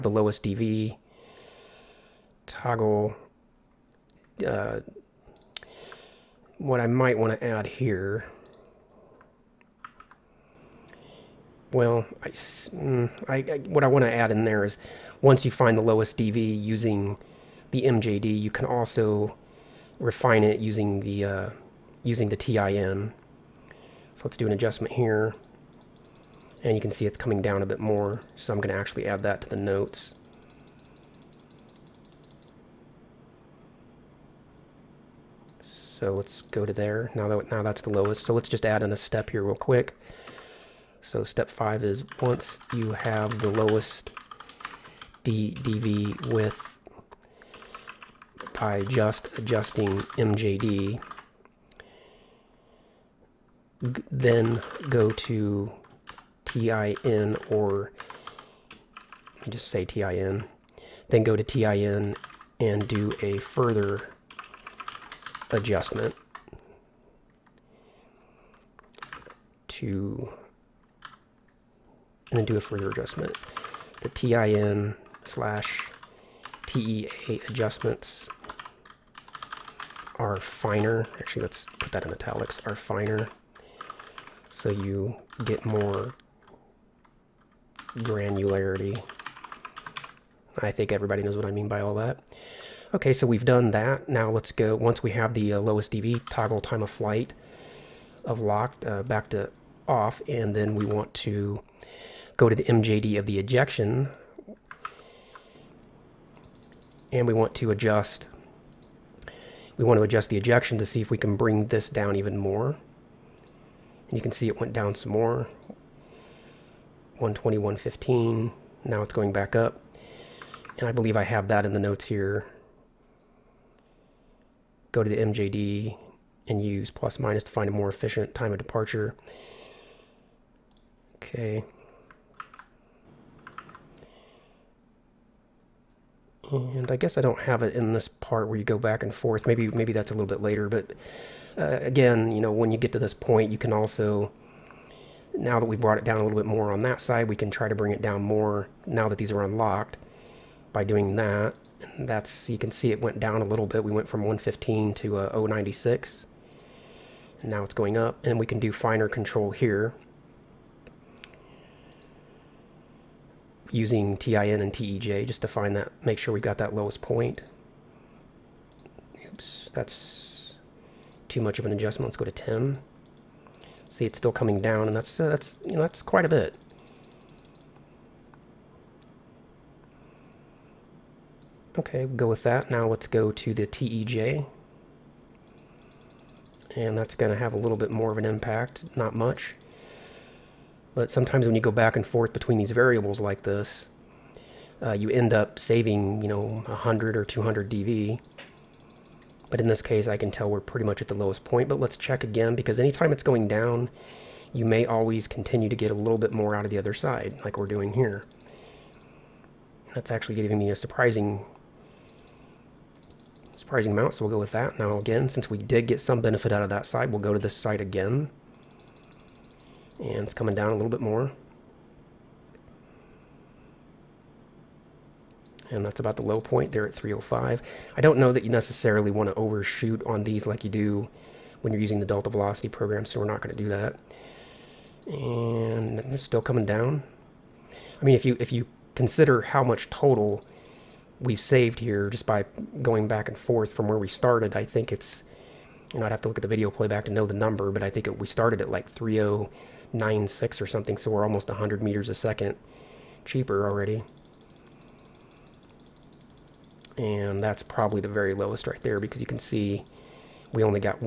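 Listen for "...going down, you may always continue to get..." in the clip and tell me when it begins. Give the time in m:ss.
3:23.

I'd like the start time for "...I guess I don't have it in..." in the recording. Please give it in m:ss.
2:16.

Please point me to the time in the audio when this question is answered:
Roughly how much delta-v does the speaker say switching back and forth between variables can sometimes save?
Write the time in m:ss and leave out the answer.
3:16.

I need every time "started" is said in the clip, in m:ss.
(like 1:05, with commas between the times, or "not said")
4:04, 4:08.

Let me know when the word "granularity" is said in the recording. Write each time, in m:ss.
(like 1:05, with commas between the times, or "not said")
1:27.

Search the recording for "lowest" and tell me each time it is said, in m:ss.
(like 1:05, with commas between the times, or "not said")
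0:00, 0:15, 0:37, 0:43, 1:35, 2:46, 3:21, 4:18.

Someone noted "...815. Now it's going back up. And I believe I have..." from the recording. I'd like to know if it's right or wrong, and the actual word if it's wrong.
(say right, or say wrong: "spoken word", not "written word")
wrong: "115", not "815".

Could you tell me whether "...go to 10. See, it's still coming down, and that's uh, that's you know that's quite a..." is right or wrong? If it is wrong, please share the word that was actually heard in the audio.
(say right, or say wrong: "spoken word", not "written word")
right.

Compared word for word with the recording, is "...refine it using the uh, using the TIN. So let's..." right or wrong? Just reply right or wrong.
right.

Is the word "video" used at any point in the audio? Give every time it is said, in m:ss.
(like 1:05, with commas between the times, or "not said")
4:06.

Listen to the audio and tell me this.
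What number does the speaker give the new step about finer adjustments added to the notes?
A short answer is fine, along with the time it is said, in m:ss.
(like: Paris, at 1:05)
5, at 0:41.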